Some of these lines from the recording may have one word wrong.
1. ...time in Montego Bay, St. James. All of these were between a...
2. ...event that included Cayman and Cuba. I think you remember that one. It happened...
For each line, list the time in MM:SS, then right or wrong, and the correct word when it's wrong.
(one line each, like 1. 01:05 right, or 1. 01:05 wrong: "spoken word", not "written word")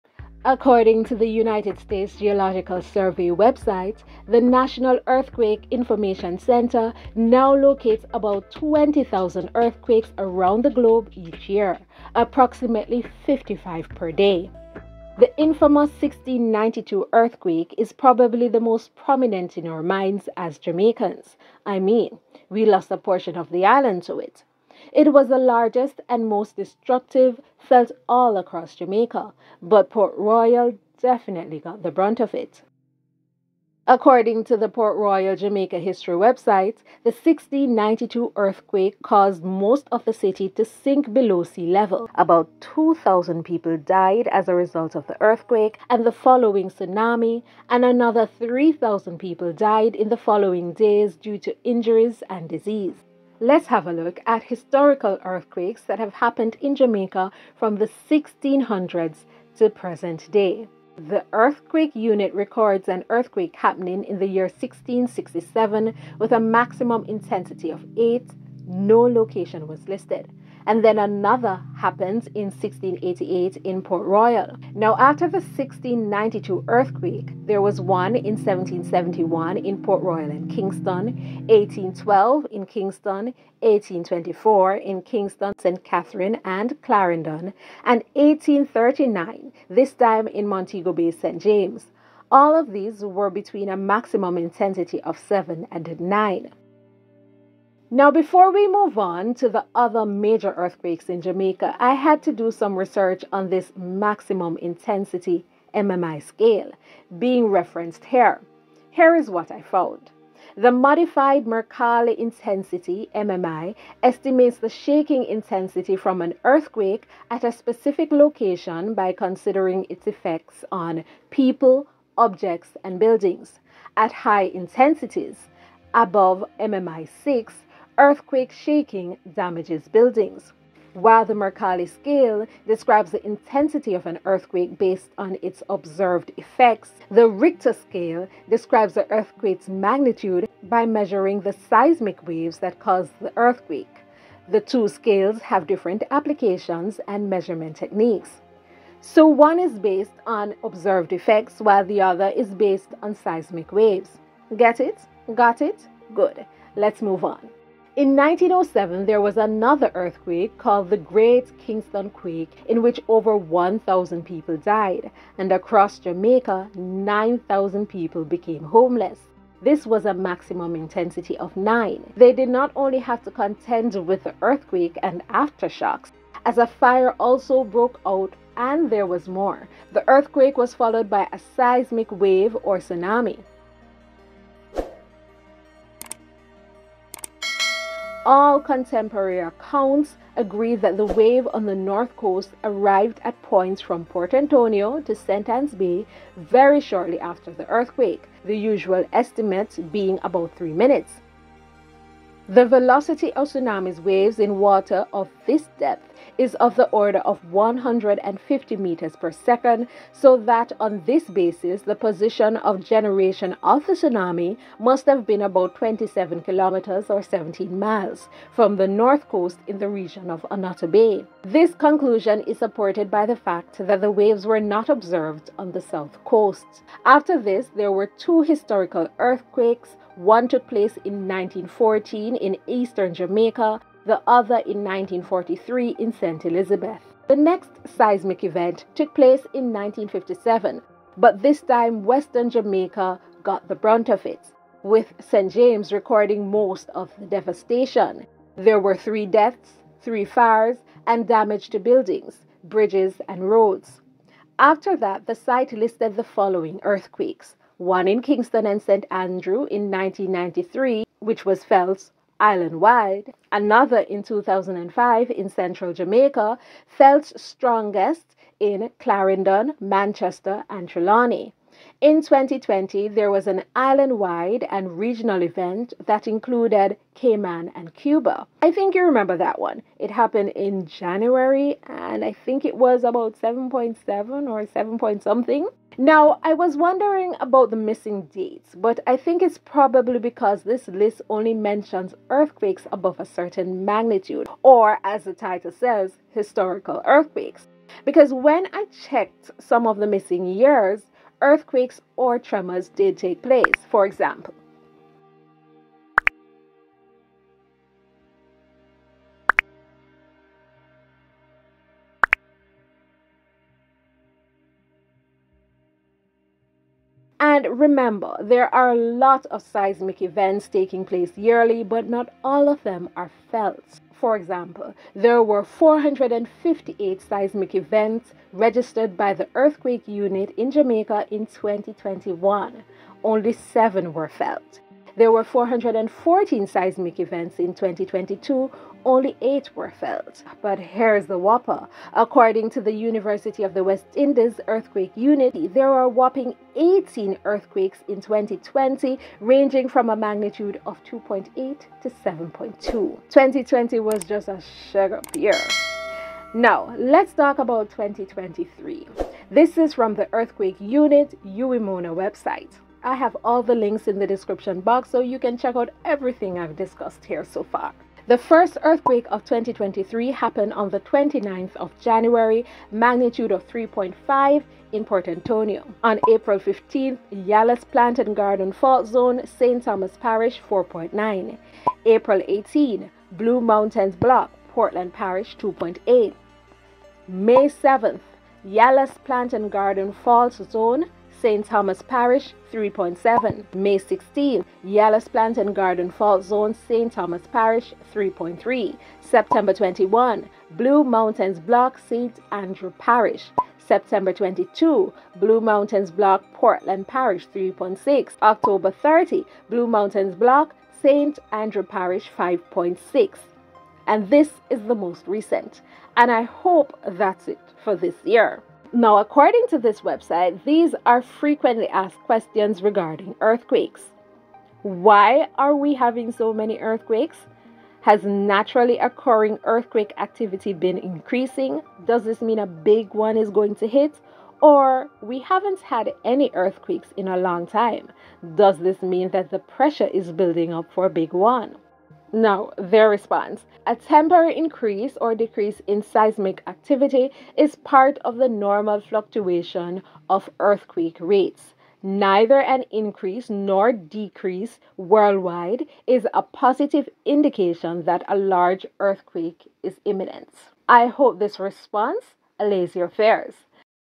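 1. 01:29 right
2. 04:35 right.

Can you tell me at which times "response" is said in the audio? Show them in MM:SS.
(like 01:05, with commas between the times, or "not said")
07:23, 07:41.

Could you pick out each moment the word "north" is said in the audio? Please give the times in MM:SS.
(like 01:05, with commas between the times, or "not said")
03:11, 03:38.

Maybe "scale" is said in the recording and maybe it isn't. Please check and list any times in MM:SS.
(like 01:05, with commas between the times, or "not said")
01:46, 02:11, 02:17, 02:24.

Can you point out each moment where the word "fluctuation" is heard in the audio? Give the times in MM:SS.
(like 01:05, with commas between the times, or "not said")
07:29.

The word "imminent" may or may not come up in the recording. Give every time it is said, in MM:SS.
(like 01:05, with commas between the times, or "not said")
07:40.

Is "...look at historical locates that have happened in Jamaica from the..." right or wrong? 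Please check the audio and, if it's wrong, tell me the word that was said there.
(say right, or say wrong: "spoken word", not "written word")
wrong: "earthquakes", not "locates".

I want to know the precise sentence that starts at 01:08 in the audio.
No location was listed and then another happens in 1688 in Port Royal.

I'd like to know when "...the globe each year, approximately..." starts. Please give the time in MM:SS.
00:10.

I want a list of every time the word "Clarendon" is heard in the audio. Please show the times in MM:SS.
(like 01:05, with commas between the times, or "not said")
01:26, 04:28.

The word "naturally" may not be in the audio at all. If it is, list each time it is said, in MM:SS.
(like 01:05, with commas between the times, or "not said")
07:08.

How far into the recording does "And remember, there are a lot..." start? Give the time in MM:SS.
05:17.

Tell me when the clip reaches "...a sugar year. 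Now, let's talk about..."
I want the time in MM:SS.
05:54.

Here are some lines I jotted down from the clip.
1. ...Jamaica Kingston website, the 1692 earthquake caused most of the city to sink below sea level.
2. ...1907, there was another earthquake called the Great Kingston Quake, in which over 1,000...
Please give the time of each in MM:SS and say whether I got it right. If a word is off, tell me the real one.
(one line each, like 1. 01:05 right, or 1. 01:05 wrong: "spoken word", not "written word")
1. 00:35 wrong: "History", not "Kingston"
2. 02:38 right.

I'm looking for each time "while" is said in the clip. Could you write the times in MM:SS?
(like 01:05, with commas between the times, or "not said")
02:10, 02:31.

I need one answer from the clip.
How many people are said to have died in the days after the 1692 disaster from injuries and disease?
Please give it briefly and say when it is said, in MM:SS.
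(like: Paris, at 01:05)
3,000, at 00:47.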